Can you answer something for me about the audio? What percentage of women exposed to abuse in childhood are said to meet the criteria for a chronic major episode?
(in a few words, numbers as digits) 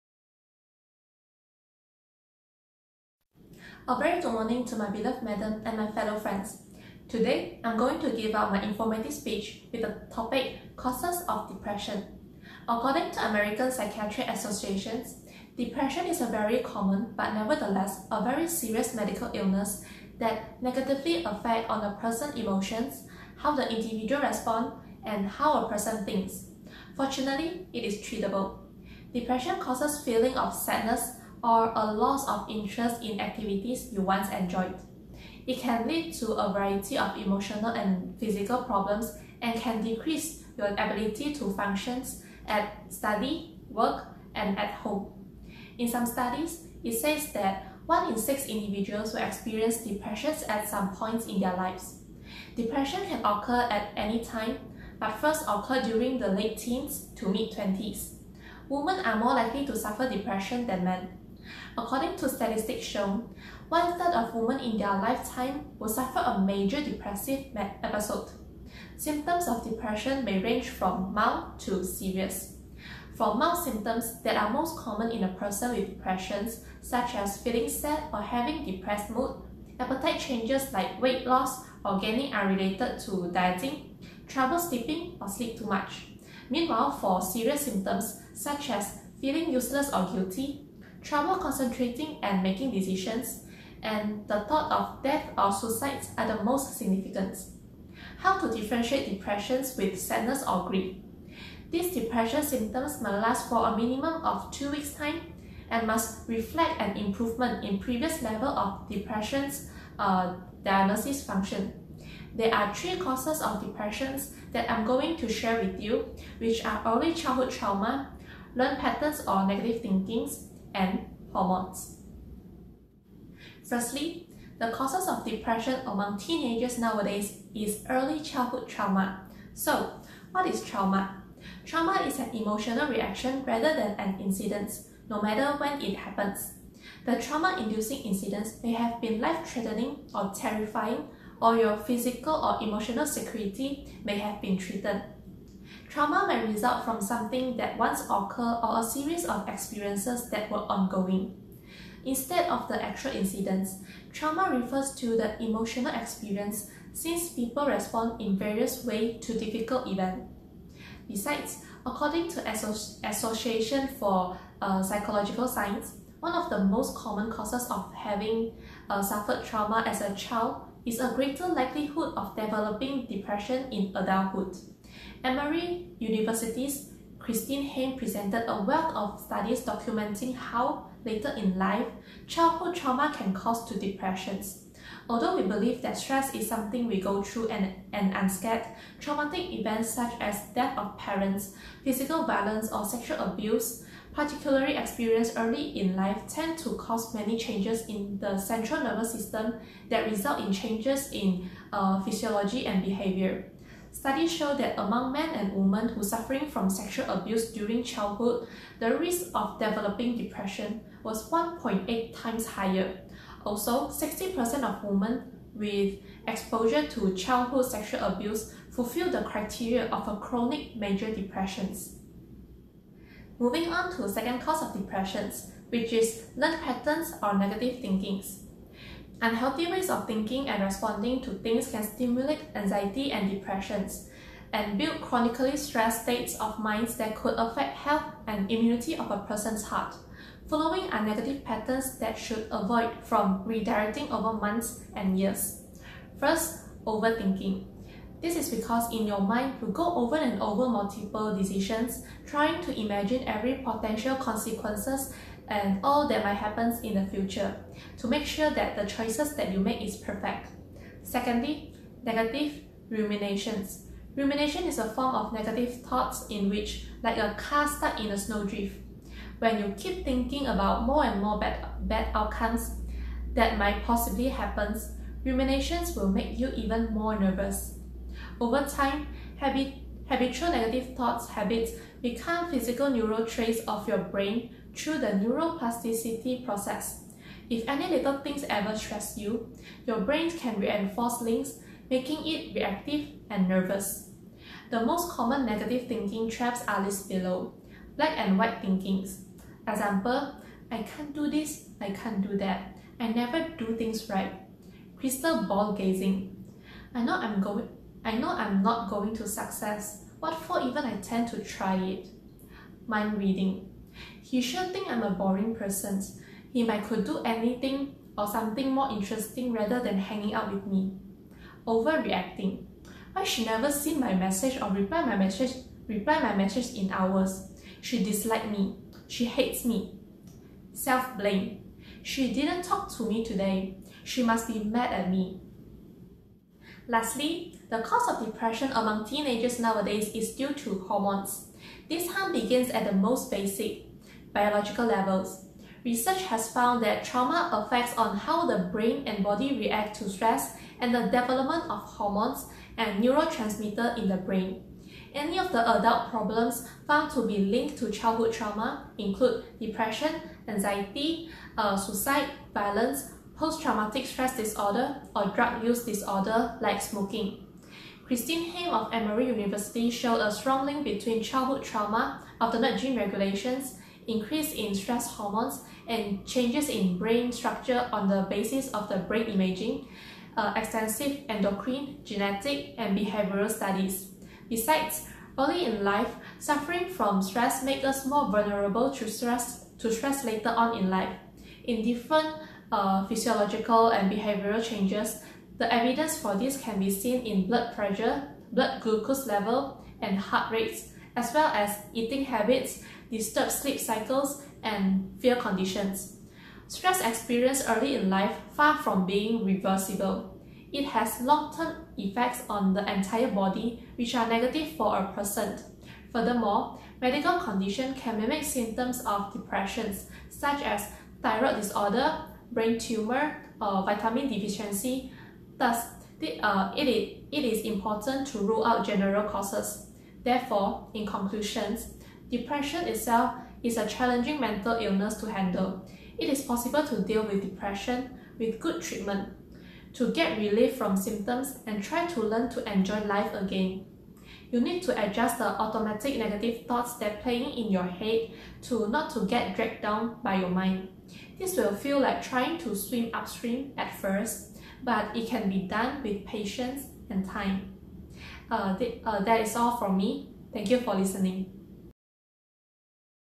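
60%.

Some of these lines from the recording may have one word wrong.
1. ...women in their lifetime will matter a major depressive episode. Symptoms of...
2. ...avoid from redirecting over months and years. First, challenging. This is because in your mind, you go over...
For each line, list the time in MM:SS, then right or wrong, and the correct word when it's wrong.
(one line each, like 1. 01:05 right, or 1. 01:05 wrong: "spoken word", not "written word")
1. 01:04 wrong: "suffer", not "matter"
2. 04:02 wrong: "overthinking", not "challenging".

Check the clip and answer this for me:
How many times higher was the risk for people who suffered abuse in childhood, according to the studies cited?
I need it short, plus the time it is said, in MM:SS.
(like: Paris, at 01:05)
1.8 times, at 03:31.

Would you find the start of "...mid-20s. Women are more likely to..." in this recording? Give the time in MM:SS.
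00:57.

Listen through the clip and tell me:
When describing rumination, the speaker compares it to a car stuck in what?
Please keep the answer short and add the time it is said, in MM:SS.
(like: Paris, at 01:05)
a snowdrift, at 04:28.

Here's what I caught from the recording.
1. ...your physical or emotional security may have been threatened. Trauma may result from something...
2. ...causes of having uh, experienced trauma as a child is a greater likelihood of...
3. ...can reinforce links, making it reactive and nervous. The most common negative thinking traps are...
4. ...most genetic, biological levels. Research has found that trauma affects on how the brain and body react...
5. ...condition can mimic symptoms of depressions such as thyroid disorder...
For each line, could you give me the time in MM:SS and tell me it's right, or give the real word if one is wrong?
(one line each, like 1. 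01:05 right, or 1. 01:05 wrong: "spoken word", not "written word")
1. 02:21 right
2. 02:47 wrong: "suffered", not "experienced"
3. 04:50 right
4. 05:42 wrong: "basic", not "genetic"
5. 06:57 right.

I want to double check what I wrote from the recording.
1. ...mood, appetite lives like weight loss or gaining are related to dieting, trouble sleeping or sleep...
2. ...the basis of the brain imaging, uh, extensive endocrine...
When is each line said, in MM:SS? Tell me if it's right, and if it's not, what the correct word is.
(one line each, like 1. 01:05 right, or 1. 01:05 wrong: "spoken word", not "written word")
1. 01:19 wrong: "changes", not "lives"
2. 06:18 right.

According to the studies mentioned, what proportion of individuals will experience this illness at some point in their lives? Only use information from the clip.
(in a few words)
1 in 6.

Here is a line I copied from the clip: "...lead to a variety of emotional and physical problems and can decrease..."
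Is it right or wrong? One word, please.
right.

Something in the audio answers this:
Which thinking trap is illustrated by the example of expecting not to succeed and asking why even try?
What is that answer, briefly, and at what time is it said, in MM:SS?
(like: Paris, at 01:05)
Crystal ball gazing, at 05:04.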